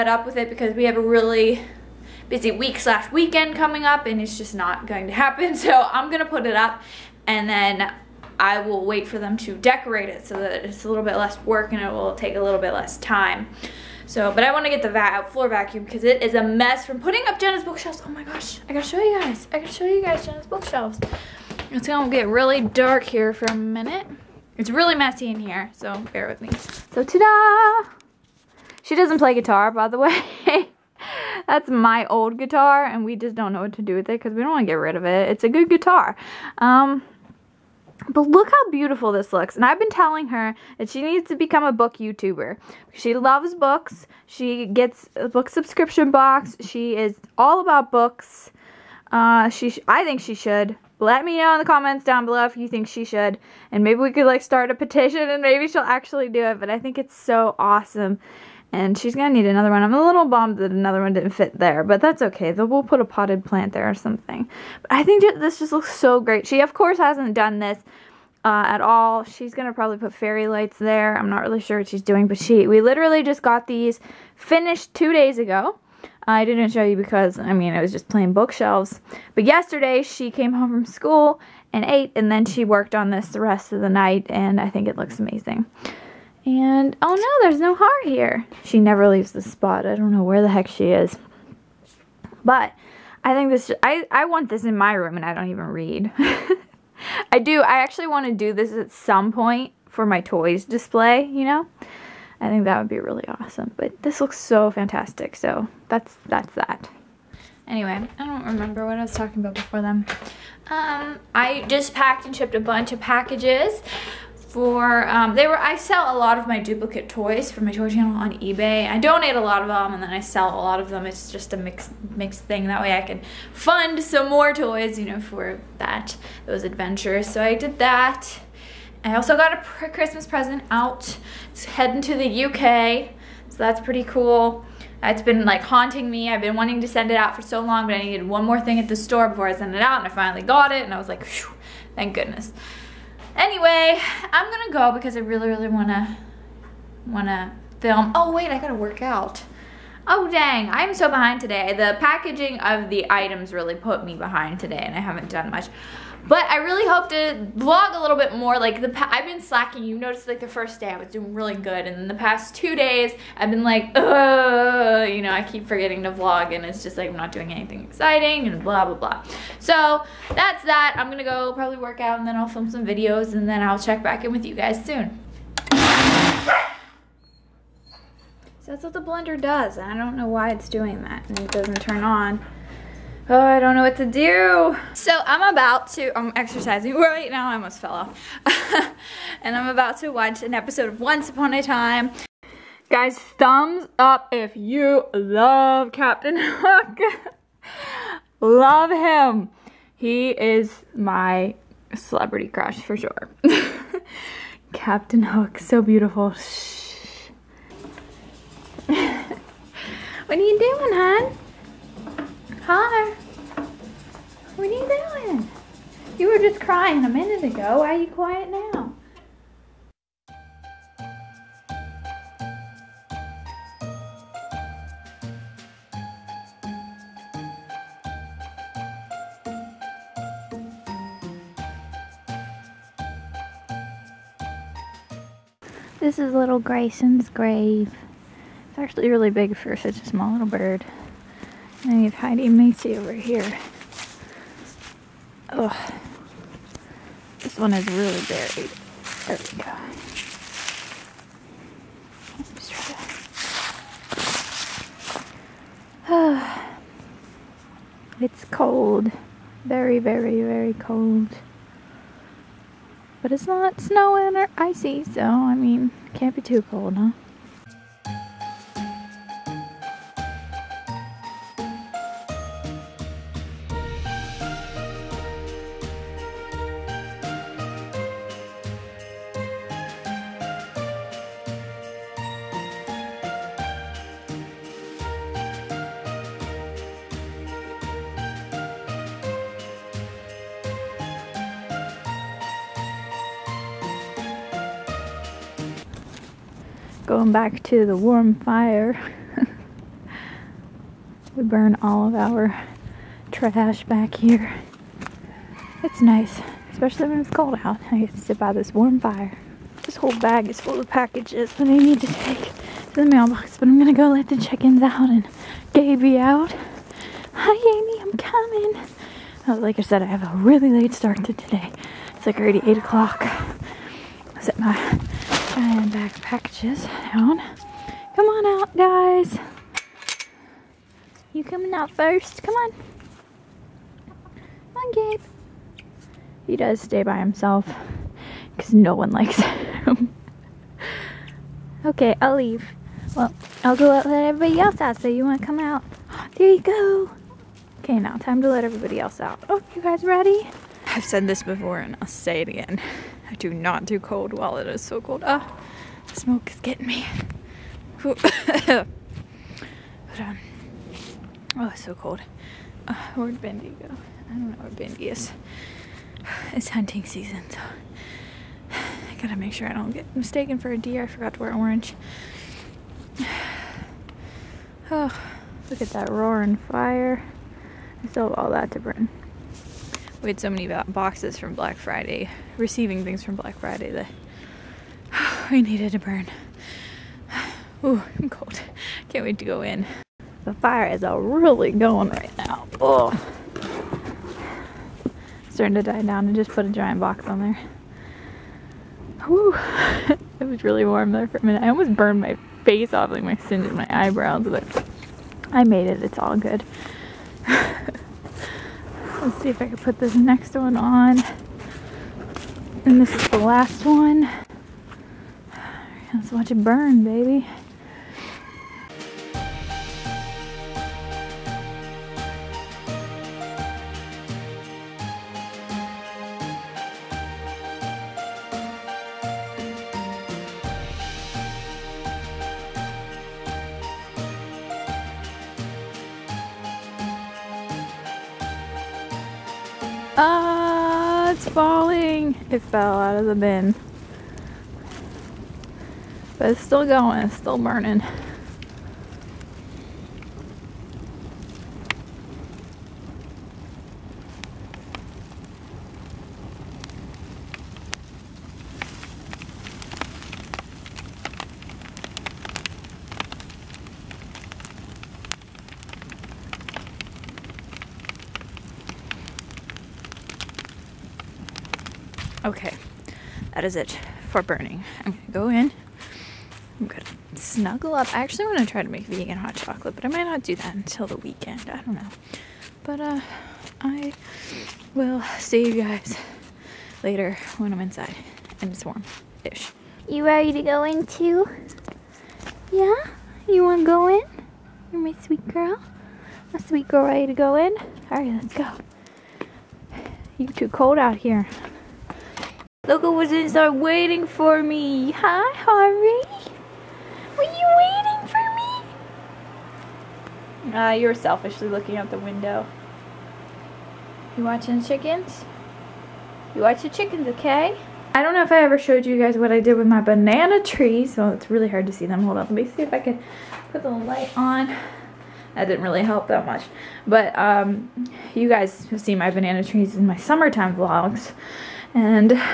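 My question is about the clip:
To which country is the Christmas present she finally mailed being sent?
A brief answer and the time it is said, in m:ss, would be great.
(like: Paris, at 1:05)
UK, at 2:12.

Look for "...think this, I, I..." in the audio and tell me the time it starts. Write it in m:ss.
1:33.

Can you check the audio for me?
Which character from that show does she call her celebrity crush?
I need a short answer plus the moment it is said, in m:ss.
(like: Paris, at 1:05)
Captain Hook, at 3:24.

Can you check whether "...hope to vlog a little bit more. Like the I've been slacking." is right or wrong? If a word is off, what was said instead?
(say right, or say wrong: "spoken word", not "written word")
right.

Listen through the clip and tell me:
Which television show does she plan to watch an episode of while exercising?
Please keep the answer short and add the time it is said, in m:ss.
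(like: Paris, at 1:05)
Once Upon a Time, at 3:11.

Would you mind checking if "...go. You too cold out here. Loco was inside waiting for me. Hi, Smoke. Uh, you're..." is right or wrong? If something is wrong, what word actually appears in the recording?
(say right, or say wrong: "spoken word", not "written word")
wrong: "Harvey", not "Smoke".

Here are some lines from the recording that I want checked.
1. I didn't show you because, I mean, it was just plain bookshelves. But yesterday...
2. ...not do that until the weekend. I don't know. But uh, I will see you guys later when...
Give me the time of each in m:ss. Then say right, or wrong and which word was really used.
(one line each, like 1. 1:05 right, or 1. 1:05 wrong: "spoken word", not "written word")
1. 1:16 right
2. 8:00 right.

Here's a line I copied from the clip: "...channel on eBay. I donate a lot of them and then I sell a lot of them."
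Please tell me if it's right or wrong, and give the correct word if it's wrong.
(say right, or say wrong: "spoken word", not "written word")
right.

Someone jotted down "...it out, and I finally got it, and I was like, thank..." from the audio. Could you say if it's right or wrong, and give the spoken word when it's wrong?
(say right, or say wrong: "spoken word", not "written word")
right.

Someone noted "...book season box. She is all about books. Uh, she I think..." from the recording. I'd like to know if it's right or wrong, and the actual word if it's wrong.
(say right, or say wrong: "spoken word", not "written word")
wrong: "subscription", not "season".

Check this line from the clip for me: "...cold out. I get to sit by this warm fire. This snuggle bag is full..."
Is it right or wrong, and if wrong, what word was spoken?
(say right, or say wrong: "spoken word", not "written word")
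wrong: "whole", not "snuggle".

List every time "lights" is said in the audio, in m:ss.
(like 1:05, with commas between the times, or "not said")
1:10, 8:43.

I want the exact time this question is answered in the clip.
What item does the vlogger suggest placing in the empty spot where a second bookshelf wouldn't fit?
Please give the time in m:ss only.
1:03.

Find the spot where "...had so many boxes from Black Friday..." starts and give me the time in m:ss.
6:20.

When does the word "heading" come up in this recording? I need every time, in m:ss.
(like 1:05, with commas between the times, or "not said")
2:11.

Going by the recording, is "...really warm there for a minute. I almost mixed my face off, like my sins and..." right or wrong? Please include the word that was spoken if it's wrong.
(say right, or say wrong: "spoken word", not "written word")
wrong: "burned", not "mixed".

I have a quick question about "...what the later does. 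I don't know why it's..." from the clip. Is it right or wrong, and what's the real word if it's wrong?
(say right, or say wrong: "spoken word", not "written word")
wrong: "blender", not "later".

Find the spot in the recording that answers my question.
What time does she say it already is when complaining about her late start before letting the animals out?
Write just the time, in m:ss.
5:22.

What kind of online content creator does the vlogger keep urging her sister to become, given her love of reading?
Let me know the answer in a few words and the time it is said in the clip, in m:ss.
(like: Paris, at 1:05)
Book YouTuber, at 0:41.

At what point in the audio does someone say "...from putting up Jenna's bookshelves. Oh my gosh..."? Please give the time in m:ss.
0:16.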